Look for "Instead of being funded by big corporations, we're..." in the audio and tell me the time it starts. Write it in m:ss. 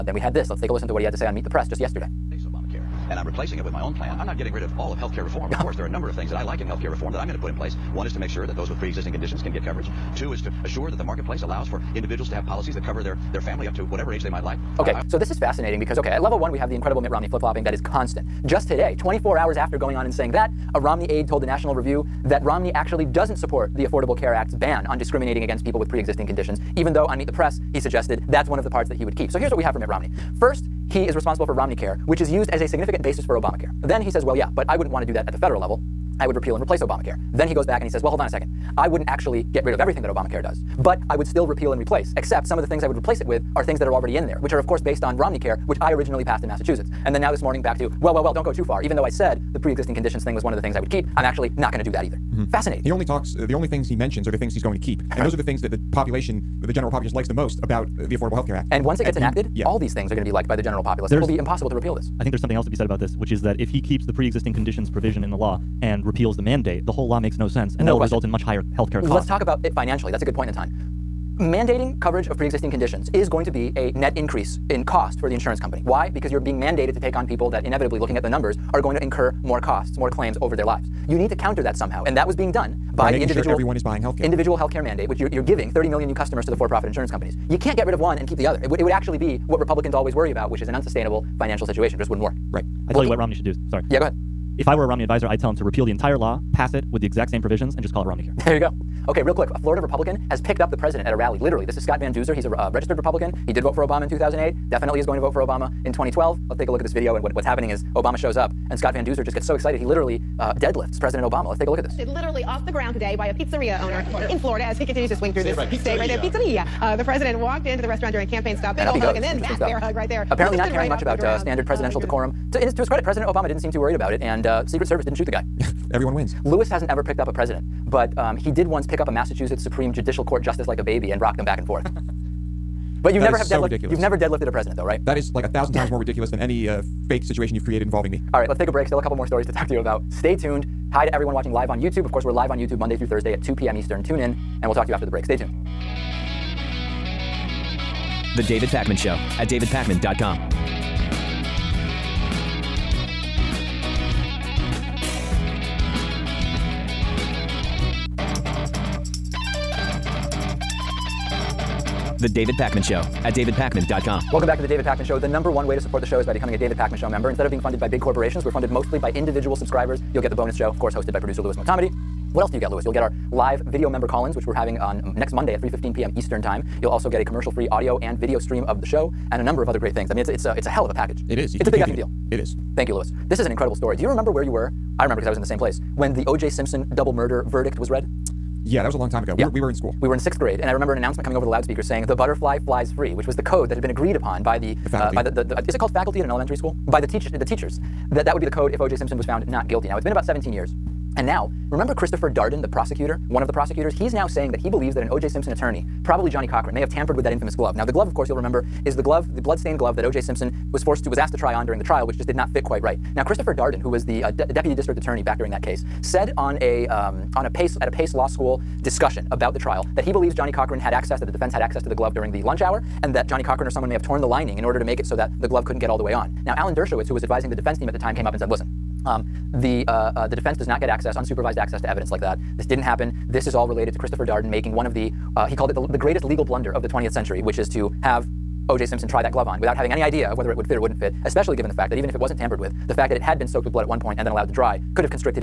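2:47.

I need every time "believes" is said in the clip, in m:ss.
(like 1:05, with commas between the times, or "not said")
3:24, 3:40.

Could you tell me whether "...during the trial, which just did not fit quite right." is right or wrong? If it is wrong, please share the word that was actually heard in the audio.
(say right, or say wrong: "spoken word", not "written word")
right.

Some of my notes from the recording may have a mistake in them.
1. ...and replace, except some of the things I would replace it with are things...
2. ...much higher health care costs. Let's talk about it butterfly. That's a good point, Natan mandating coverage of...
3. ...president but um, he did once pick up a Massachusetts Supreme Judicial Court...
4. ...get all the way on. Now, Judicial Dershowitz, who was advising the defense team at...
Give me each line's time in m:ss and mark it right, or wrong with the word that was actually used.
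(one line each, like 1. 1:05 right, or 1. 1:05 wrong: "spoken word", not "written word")
1. 0:41 right
2. 1:08 wrong: "financially", not "butterfly"
3. 2:07 right
4. 3:45 wrong: "Alan", not "Judicial".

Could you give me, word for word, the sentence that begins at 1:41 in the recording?
Literally, this is Scott Van Duzer.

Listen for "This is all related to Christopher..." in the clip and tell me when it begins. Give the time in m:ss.
3:53.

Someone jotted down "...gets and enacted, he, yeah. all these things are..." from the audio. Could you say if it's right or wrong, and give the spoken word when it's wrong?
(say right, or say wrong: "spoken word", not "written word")
right.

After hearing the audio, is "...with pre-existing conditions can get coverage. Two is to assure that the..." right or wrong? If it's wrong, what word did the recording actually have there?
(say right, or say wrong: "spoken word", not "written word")
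right.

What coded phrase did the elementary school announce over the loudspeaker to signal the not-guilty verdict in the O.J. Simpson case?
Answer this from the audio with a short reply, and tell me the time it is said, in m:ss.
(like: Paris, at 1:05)
The butterfly flies free, at 3:12.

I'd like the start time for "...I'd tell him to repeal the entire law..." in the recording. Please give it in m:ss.
1:35.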